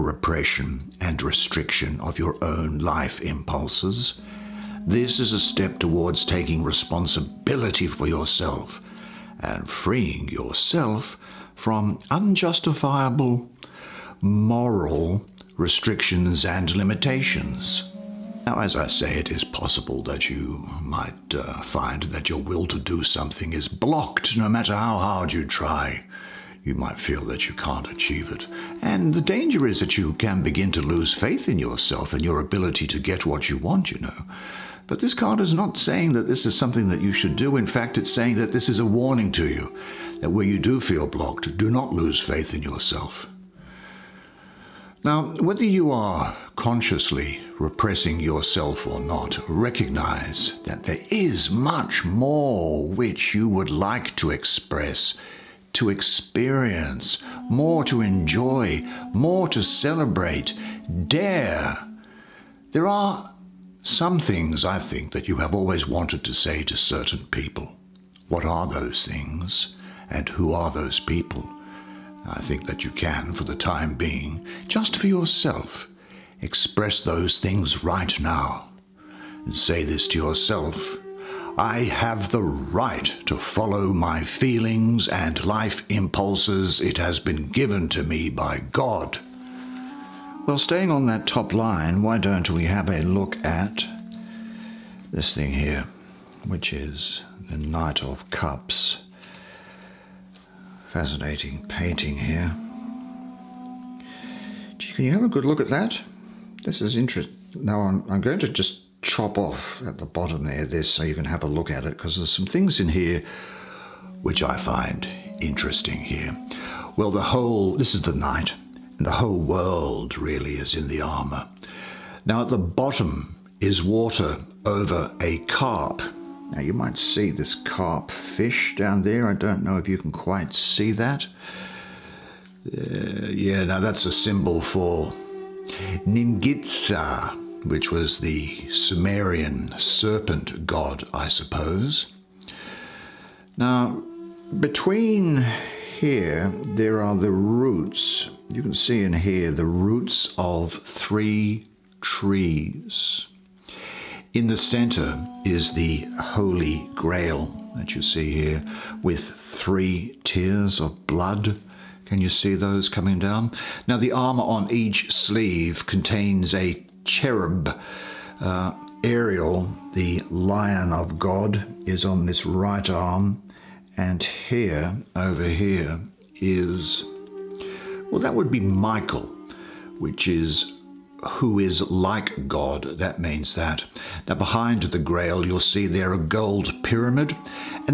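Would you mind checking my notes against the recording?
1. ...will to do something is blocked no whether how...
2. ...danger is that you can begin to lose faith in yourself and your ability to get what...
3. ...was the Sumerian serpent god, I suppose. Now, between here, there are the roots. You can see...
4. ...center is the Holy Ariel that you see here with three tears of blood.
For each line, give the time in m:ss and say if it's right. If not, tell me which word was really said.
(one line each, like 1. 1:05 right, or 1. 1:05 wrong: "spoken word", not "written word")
1. 0:22 wrong: "matter", not "whether"
2. 0:29 right
3. 2:17 right
4. 2:34 wrong: "Grail", not "Ariel".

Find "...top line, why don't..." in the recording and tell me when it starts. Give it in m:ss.
1:31.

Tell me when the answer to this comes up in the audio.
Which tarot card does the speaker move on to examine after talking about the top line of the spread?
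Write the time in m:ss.
1:37.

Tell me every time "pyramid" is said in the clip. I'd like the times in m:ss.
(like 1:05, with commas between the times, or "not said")
3:06.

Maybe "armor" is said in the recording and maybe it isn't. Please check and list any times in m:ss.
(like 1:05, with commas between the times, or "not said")
2:01, 2:44.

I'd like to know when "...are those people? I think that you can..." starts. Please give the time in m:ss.
1:10.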